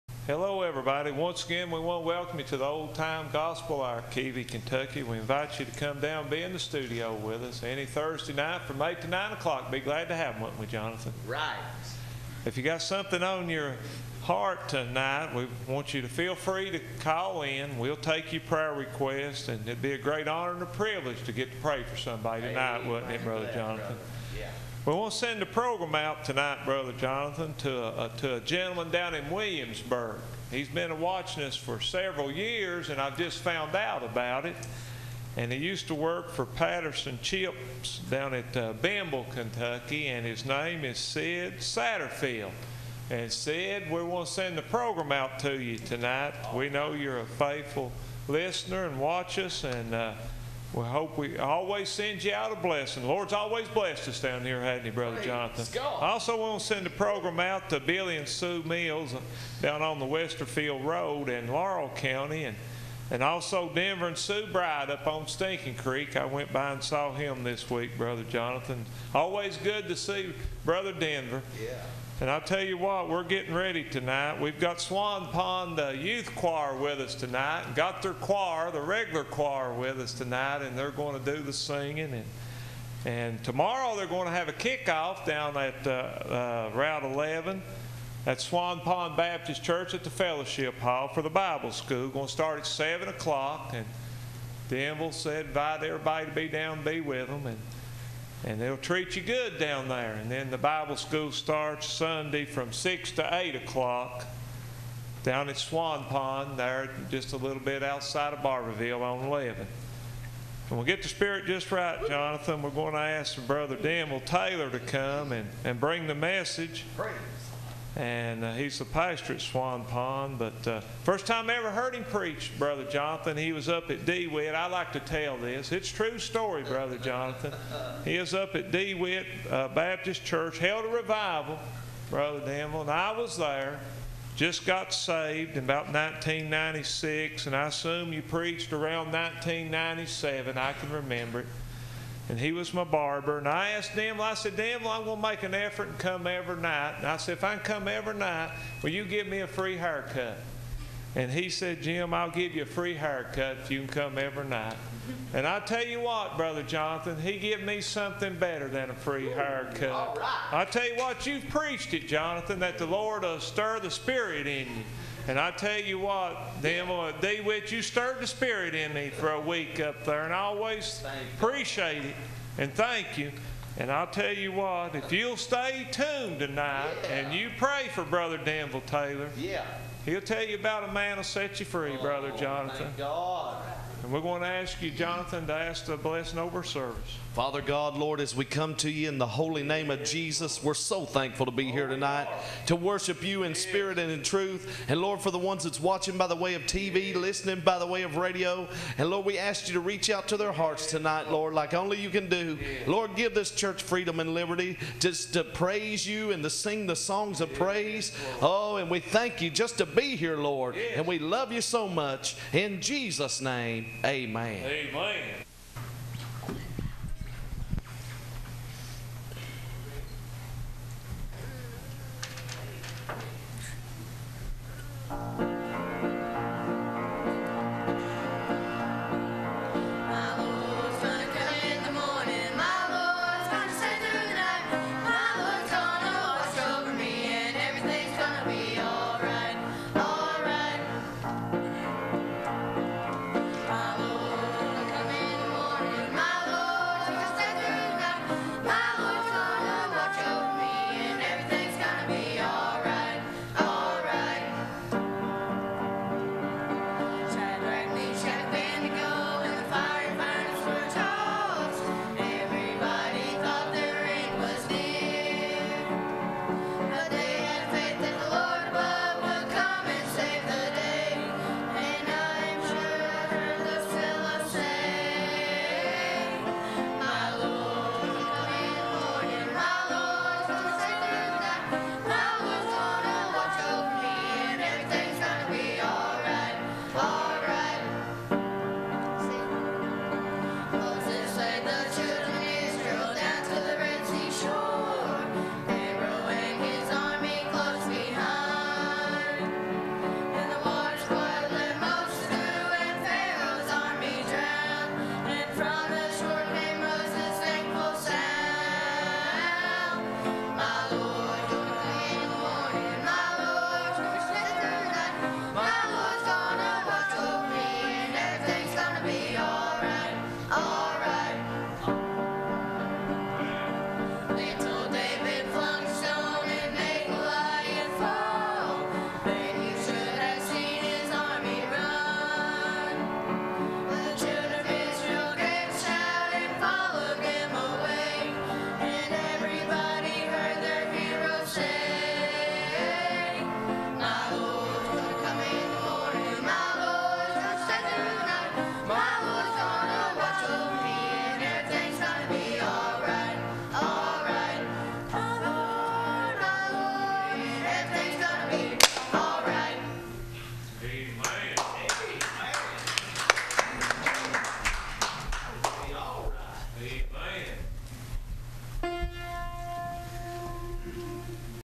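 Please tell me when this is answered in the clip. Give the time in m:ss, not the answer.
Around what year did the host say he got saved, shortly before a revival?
2:15.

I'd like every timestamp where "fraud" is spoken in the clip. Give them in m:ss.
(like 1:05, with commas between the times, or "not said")
not said.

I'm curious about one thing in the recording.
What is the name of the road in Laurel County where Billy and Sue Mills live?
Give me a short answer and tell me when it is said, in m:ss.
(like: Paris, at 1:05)
Westerfield Road, at 1:00.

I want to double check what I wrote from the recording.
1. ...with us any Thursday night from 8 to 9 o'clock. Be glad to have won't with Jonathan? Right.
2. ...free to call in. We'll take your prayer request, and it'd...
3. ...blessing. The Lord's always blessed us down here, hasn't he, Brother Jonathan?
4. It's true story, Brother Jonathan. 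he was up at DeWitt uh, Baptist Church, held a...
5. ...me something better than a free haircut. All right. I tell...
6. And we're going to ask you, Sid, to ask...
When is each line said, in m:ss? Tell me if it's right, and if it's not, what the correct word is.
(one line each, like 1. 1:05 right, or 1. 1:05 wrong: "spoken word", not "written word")
1. 0:07 right
2. 0:16 right
3. 0:52 right
4. 2:05 right
5. 2:37 right
6. 3:04 wrong: "Jonathan", not "Sid".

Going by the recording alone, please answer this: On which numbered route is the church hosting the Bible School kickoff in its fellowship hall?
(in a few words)
Route 11.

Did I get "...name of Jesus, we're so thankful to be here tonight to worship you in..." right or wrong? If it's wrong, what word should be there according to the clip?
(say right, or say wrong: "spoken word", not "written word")
right.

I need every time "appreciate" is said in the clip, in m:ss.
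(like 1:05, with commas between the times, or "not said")
2:51.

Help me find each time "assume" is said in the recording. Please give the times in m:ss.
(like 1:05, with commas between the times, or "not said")
2:17.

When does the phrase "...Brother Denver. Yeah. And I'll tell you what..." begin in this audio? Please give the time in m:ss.
1:10.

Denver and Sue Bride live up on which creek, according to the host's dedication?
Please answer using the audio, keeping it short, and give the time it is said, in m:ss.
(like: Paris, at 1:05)
Stinking Creek, at 1:05.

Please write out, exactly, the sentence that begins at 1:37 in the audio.
And, and they'll treat you good down there.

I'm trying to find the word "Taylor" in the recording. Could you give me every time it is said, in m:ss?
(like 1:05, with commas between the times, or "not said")
1:54, 2:58.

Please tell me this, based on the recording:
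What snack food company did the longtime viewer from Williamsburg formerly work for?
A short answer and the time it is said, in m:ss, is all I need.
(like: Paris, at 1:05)
Patterson Chips, at 0:36.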